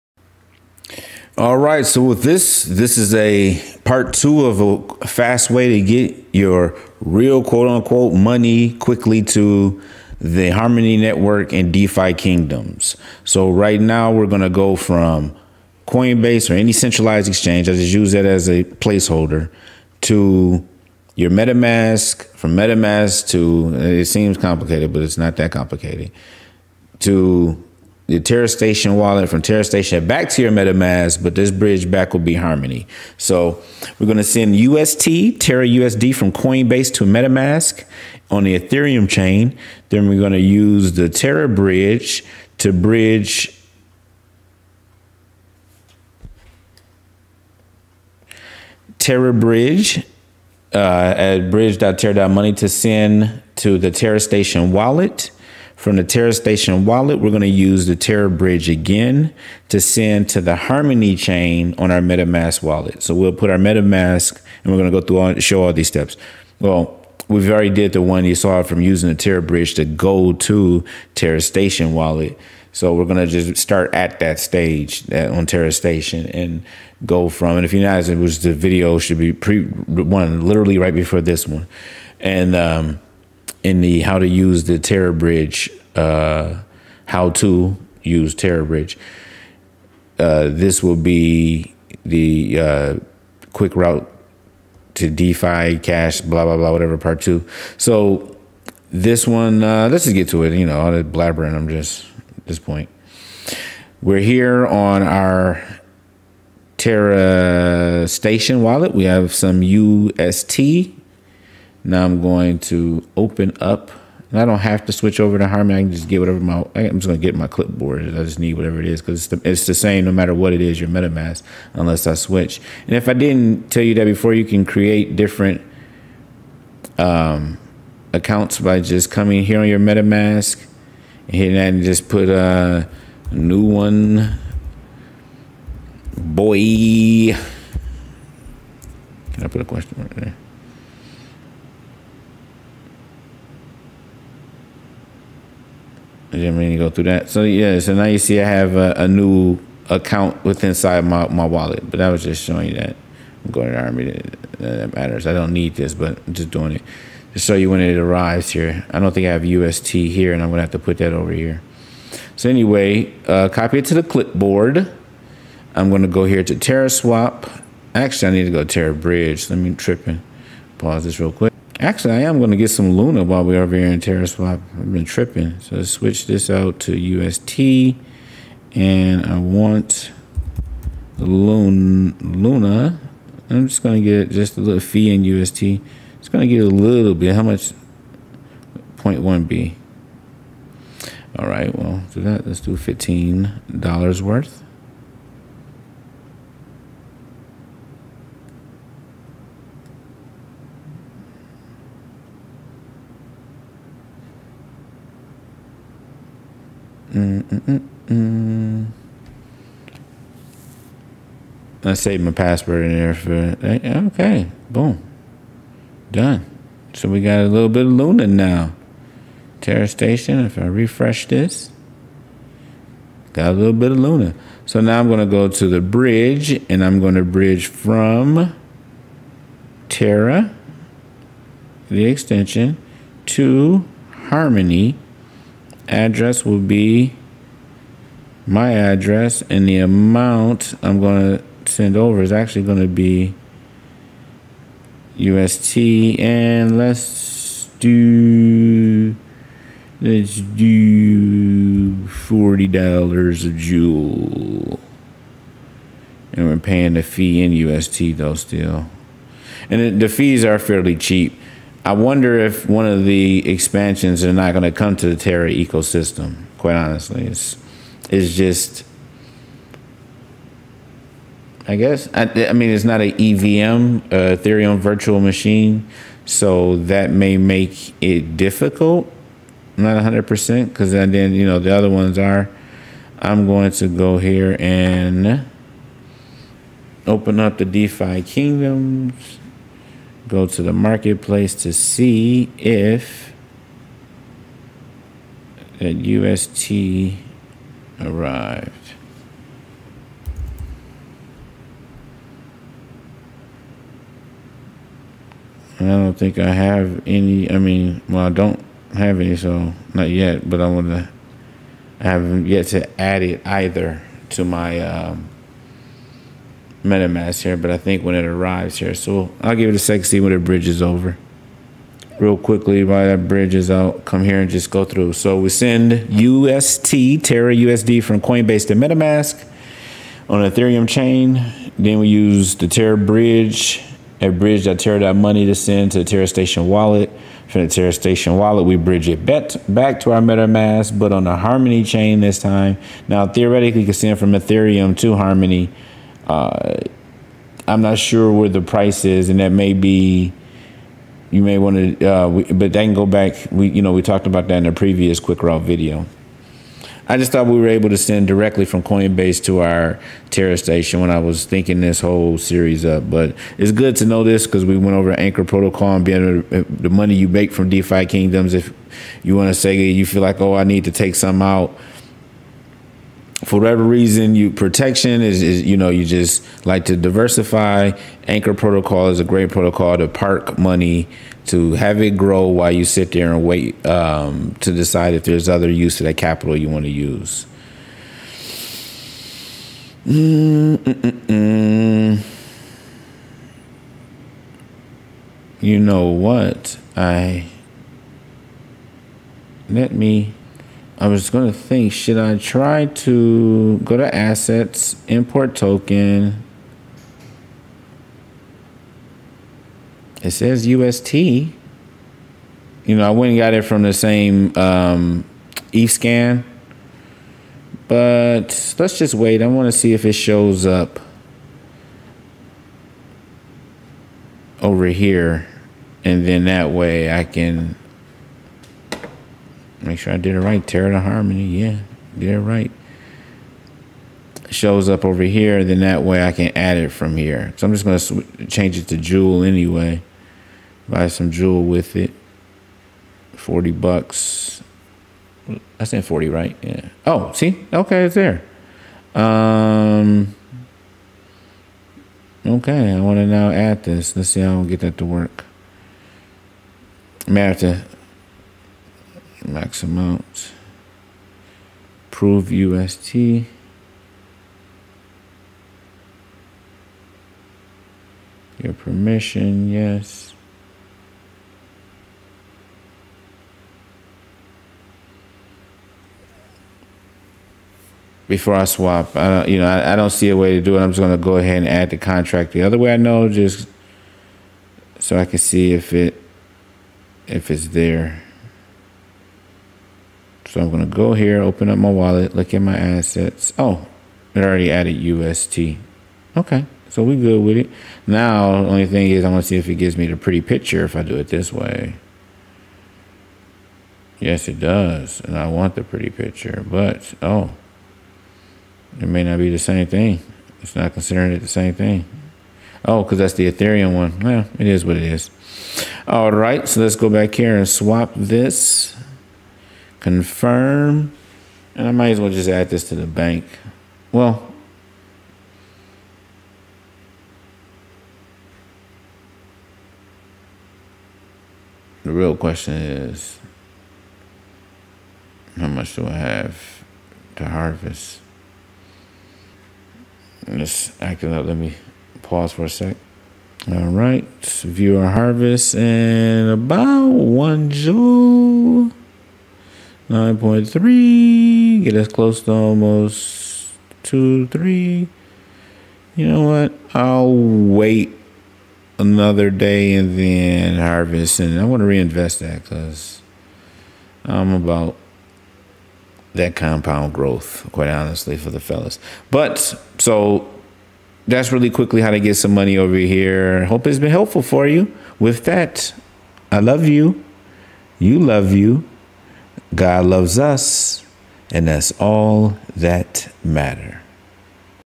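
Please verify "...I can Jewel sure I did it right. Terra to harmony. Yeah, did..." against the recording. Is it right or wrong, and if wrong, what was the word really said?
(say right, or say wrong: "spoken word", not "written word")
wrong: "Make", not "Jewel".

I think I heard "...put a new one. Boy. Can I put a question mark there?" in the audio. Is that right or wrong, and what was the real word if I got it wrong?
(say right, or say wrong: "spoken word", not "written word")
right.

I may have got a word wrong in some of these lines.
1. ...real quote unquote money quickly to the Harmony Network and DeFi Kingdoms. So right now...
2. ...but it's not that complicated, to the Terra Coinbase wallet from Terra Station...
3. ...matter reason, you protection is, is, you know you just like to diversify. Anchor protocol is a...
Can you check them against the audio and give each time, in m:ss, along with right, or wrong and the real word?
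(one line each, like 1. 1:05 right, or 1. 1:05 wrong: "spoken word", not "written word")
1. 0:06 right
2. 0:24 wrong: "Station", not "Coinbase"
3. 6:13 wrong: "whatever", not "matter".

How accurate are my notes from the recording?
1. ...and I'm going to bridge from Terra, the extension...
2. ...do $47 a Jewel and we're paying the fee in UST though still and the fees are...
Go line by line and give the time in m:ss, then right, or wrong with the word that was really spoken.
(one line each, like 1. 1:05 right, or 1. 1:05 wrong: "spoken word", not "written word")
1. 3:46 right
2. 4:10 wrong: "40", not "47".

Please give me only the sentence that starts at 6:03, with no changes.
But it's good to know this because we went over Anchor Protocol and being the money you make from DeFi Kingdoms.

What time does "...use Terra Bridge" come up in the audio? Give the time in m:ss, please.
1:28.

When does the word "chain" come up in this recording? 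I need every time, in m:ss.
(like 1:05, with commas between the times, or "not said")
0:39, 1:01, 5:30, 5:41.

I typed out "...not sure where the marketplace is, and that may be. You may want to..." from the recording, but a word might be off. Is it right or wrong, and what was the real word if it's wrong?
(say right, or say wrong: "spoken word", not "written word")
wrong: "price", not "marketplace".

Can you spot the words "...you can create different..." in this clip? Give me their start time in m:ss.
2:04.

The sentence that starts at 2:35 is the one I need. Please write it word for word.
I don't need this, but I'm just doing it to show you when it arrives here.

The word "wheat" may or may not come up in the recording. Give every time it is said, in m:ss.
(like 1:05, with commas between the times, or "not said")
not said.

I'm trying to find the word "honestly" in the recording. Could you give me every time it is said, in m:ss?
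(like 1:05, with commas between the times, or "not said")
4:26, 9:27.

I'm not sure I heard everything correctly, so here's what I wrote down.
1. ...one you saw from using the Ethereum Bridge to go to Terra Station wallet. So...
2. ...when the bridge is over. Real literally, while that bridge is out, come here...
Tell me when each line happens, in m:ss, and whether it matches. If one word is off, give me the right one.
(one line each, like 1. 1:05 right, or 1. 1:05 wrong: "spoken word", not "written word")
1. 1:08 wrong: "Terra", not "Ethereum"
2. 5:20 wrong: "quickly", not "literally".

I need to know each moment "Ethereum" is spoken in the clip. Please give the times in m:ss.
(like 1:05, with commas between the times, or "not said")
0:38, 4:34, 5:30, 5:44, 8:33.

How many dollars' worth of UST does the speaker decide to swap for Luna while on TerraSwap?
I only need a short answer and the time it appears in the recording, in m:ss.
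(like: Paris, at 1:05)
$15, at 3:12.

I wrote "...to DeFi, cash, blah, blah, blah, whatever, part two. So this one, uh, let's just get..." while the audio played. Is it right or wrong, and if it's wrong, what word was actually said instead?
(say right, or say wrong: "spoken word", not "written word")
right.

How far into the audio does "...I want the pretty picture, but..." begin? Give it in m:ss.
8:25.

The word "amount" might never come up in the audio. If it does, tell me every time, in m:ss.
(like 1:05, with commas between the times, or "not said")
3:59, 7:39.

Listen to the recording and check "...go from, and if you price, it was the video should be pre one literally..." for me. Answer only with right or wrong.
wrong.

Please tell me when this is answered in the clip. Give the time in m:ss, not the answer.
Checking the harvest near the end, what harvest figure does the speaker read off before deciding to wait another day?
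9:10.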